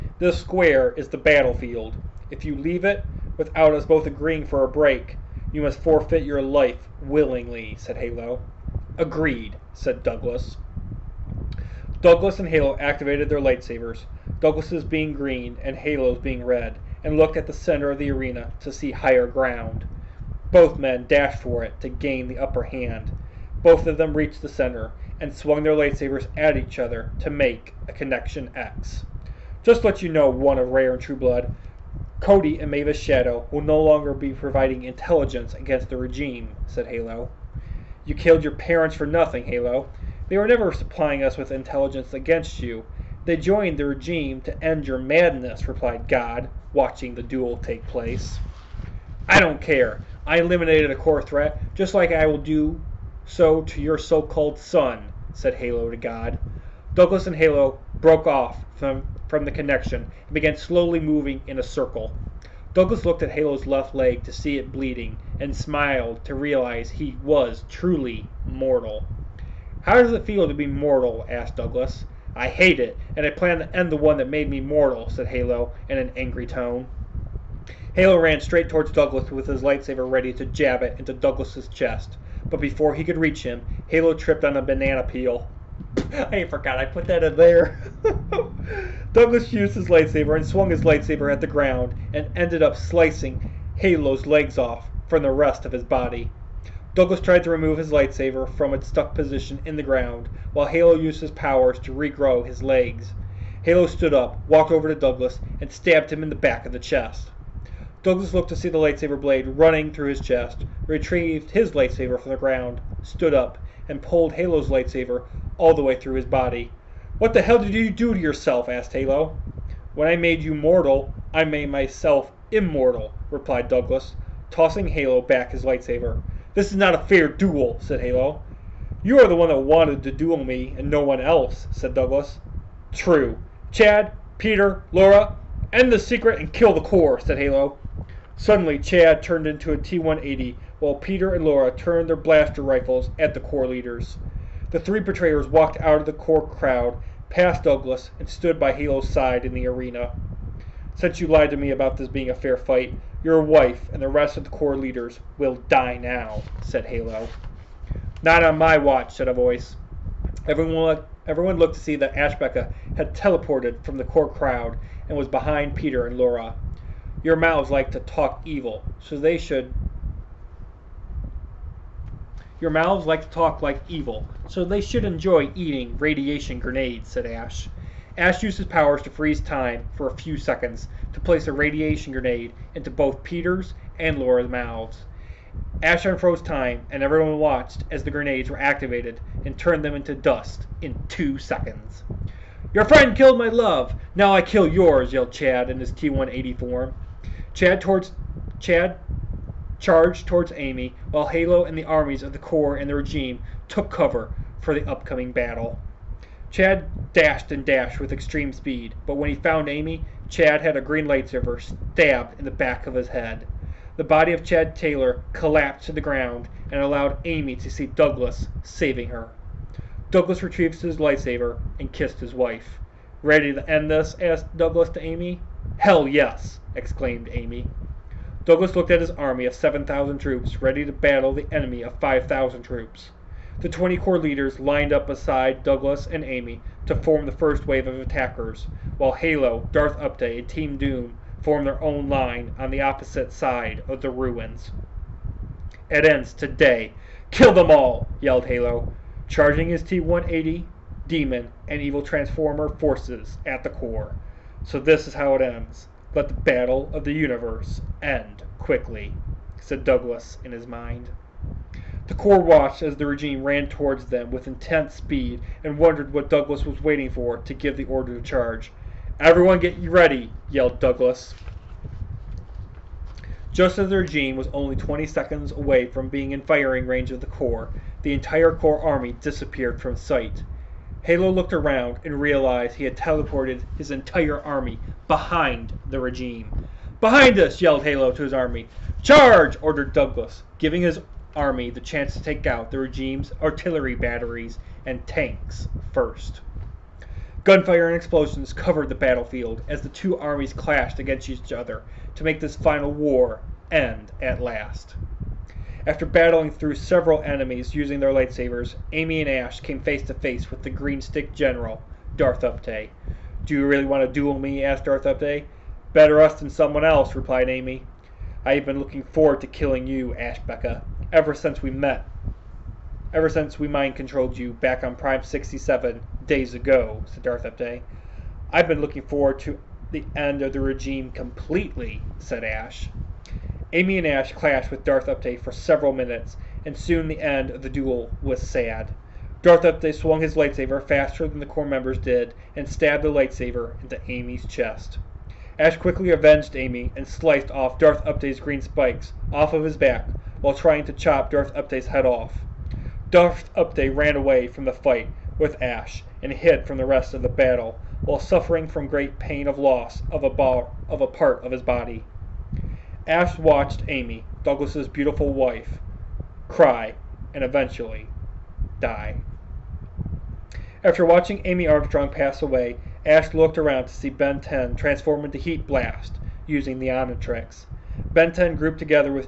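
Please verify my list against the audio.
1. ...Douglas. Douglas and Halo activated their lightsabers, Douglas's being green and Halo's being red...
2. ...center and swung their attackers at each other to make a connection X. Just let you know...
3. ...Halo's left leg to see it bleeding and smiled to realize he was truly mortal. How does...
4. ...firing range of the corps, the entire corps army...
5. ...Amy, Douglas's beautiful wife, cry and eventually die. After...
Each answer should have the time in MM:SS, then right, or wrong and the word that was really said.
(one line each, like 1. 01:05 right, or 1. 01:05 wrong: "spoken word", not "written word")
1. 00:10 right
2. 00:24 wrong: "lightsabers", not "attackers"
3. 01:03 right
4. 04:36 right
5. 06:03 right.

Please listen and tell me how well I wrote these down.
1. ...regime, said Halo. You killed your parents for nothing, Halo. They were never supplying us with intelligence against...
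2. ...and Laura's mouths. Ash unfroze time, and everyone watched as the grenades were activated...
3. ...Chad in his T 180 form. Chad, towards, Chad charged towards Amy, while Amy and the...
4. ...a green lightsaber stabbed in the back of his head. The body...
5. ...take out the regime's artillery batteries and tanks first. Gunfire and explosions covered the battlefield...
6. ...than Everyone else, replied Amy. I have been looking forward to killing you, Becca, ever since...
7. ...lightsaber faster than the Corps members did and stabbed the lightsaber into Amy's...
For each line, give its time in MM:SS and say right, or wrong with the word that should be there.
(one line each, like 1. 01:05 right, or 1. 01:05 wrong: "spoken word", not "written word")
1. 00:35 right
2. 03:03 right
3. 03:15 wrong: "Halo", not "Amy"
4. 03:30 right
5. 04:52 right
6. 05:16 wrong: "someone", not "Everyone"
7. 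05:40 right.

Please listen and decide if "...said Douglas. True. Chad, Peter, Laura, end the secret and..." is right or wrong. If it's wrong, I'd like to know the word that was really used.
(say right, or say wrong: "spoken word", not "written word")
right.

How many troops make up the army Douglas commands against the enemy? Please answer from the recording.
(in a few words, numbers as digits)
7,000.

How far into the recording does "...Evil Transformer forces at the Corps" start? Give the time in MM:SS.
04:11.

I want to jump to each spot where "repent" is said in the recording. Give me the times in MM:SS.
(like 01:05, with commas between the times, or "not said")
not said.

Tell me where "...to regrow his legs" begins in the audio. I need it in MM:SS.
01:41.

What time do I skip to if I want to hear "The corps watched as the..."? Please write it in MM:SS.
04:22.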